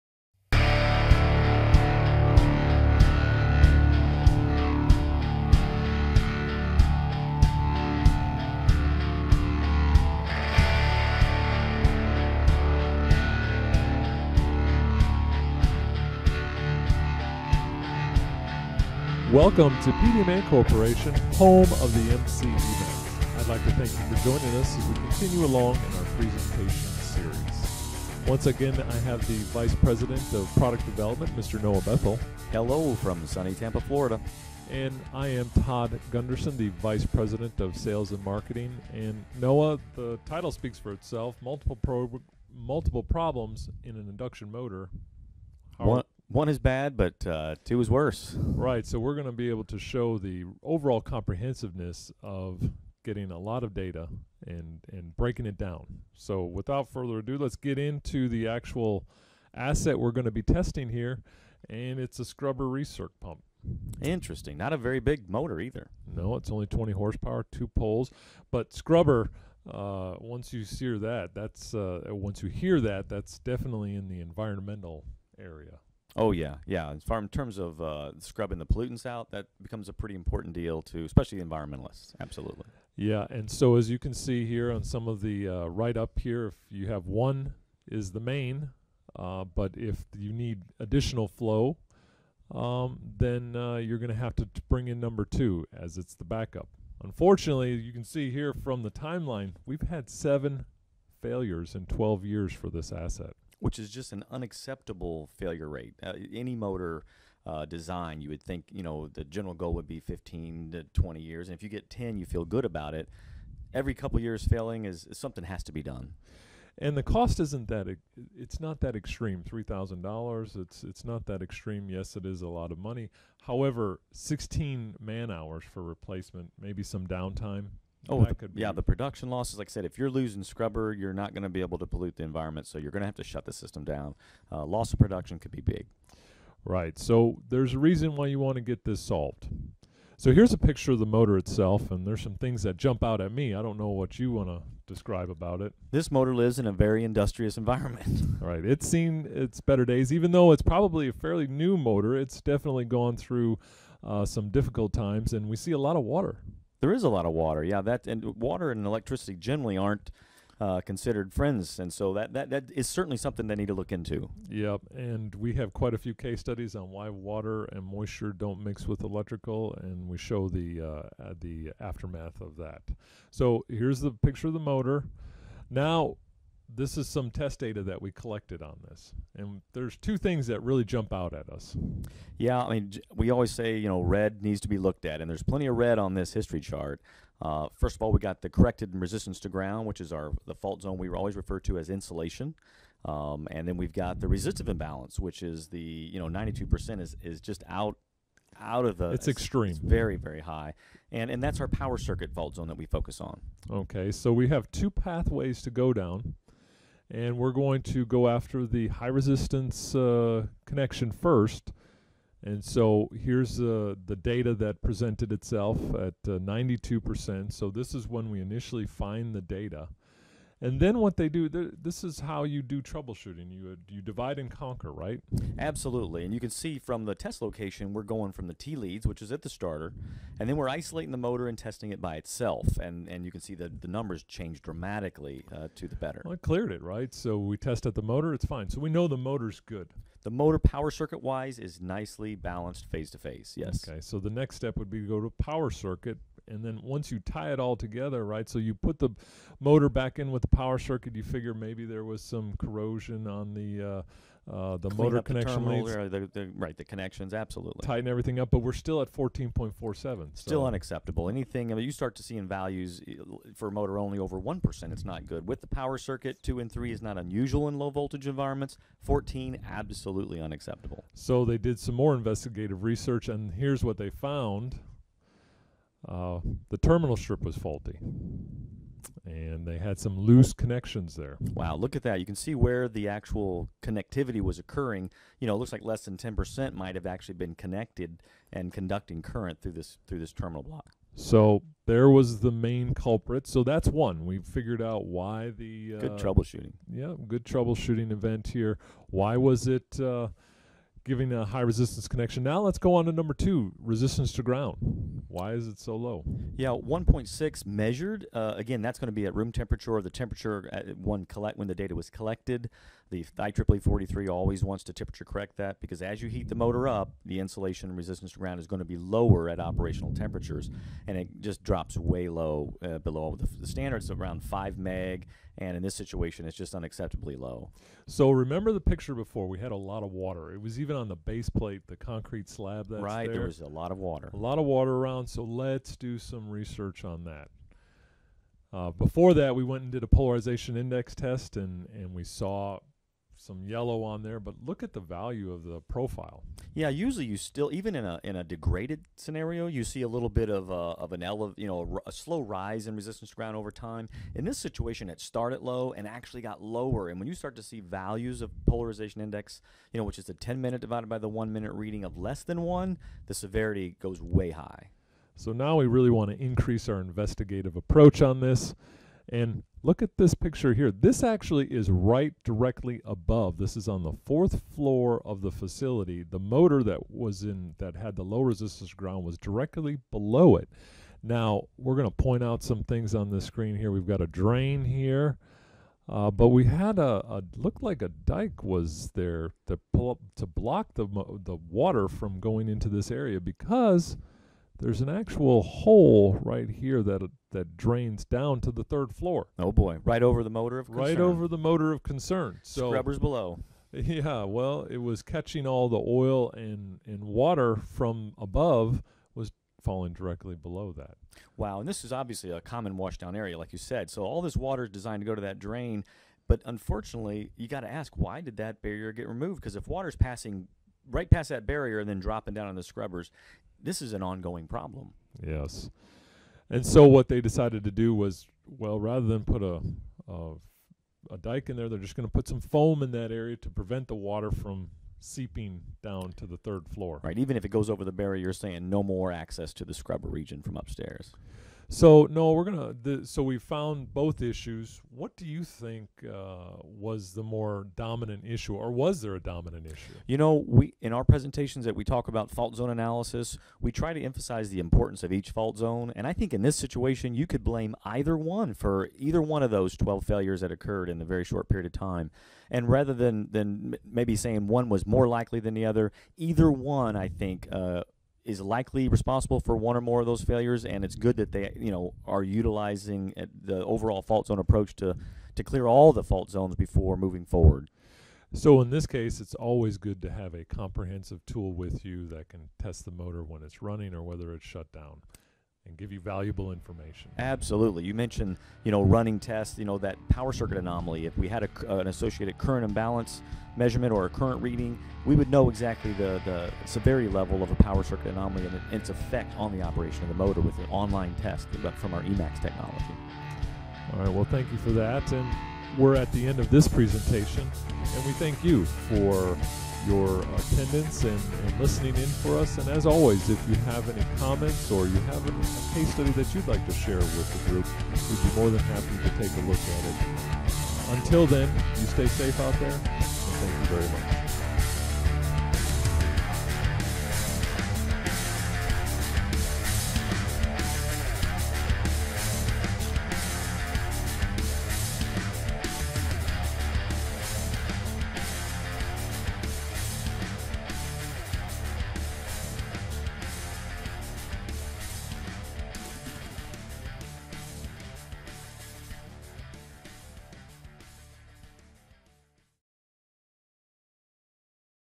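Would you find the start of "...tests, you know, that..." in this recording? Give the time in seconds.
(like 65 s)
489 s.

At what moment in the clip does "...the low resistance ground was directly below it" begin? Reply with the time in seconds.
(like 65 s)
378 s.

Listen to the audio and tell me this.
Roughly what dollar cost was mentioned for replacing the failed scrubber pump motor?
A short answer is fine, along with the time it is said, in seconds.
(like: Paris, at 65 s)
$3,000, at 119 s.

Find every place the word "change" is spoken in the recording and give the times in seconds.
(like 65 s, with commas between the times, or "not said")
234 s.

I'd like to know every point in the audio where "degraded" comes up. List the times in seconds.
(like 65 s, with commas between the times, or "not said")
348 s.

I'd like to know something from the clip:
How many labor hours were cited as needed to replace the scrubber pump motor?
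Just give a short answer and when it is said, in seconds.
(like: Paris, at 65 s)
16, at 124 s.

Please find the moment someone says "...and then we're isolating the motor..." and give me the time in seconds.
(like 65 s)
230 s.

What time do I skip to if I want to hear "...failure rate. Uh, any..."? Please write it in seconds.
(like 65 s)
105 s.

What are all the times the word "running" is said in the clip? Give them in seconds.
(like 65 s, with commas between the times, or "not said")
483 s, 489 s.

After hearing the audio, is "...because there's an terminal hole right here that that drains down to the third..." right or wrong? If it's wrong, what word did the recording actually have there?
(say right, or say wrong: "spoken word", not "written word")
wrong: "actual", not "terminal".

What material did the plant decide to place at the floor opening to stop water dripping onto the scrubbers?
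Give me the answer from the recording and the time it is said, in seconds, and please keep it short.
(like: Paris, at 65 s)
foam, at 432 s.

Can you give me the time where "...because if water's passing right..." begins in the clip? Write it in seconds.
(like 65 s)
419 s.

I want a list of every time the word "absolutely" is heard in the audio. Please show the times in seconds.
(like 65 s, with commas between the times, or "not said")
82 s, 225 s, 257 s, 269 s, 487 s.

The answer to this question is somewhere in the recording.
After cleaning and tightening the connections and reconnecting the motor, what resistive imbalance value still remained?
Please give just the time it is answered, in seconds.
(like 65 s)
259 s.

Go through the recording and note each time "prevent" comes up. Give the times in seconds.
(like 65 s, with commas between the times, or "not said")
433 s.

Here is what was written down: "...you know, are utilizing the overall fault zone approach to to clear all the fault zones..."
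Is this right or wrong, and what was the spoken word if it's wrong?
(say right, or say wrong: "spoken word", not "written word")
right.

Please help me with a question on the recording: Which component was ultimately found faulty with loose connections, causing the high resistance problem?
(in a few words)
terminal strip.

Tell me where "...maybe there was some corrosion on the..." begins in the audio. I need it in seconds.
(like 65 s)
251 s.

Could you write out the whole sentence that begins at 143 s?
I don't know what you want to describe about it.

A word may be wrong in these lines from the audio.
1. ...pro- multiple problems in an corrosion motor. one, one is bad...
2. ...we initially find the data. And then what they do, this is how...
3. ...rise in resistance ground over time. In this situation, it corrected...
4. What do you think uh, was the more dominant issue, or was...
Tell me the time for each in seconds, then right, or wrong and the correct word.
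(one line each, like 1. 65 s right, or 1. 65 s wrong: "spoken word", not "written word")
1. 41 s wrong: "induction", not "corrosion"
2. 218 s right
3. 352 s wrong: "started", not "corrected"
4. 445 s right.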